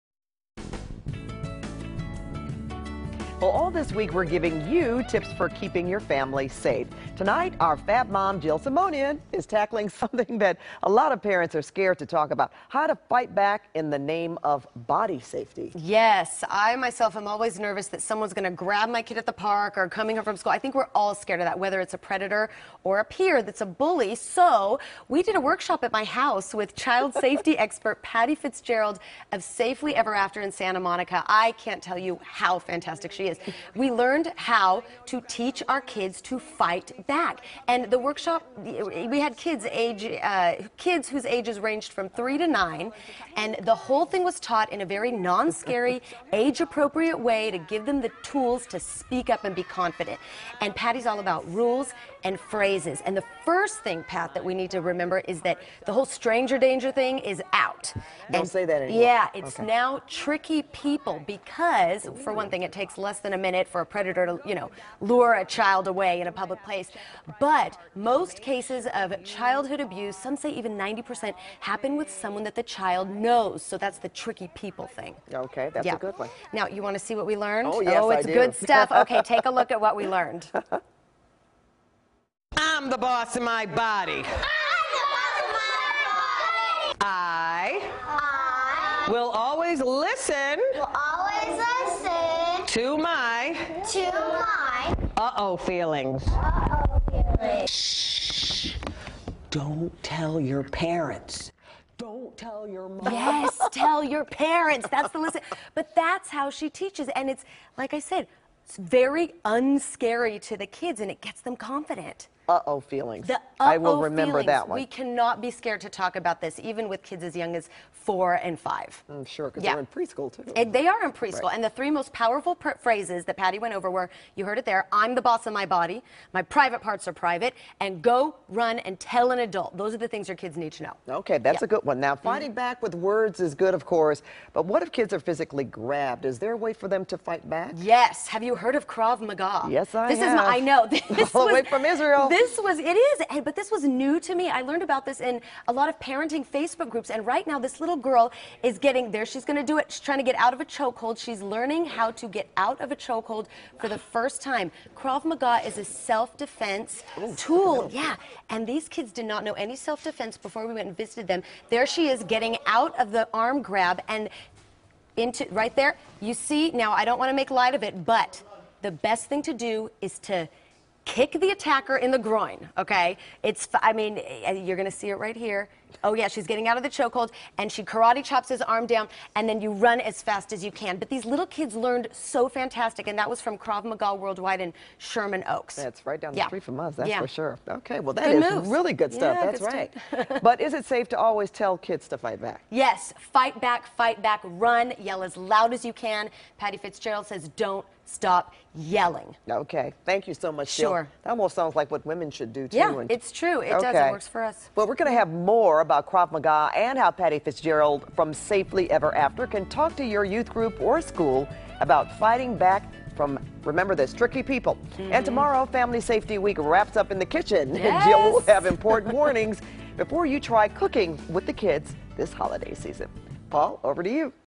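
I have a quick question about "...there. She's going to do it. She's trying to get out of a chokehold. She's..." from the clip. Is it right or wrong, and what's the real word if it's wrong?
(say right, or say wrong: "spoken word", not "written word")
right.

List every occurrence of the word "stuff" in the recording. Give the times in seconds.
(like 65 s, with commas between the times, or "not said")
78 s, 189 s.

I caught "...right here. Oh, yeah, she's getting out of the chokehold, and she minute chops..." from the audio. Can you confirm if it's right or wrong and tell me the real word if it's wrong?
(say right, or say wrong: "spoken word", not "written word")
wrong: "karate", not "minute".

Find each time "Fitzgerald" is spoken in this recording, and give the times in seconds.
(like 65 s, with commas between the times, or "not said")
28 s, 196 s, 207 s.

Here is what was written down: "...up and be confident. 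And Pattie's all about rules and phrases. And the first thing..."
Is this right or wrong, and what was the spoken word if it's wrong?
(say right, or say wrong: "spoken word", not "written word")
right.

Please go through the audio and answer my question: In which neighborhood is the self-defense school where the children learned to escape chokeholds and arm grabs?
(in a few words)
Sherman Oaks.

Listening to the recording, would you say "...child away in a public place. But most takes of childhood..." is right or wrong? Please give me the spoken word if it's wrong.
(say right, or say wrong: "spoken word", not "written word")
wrong: "cases", not "takes".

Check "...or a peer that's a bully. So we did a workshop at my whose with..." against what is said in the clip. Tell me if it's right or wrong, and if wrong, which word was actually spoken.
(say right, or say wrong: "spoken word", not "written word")
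wrong: "house", not "whose".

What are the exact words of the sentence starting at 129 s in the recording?
Those are the things your kids need to know.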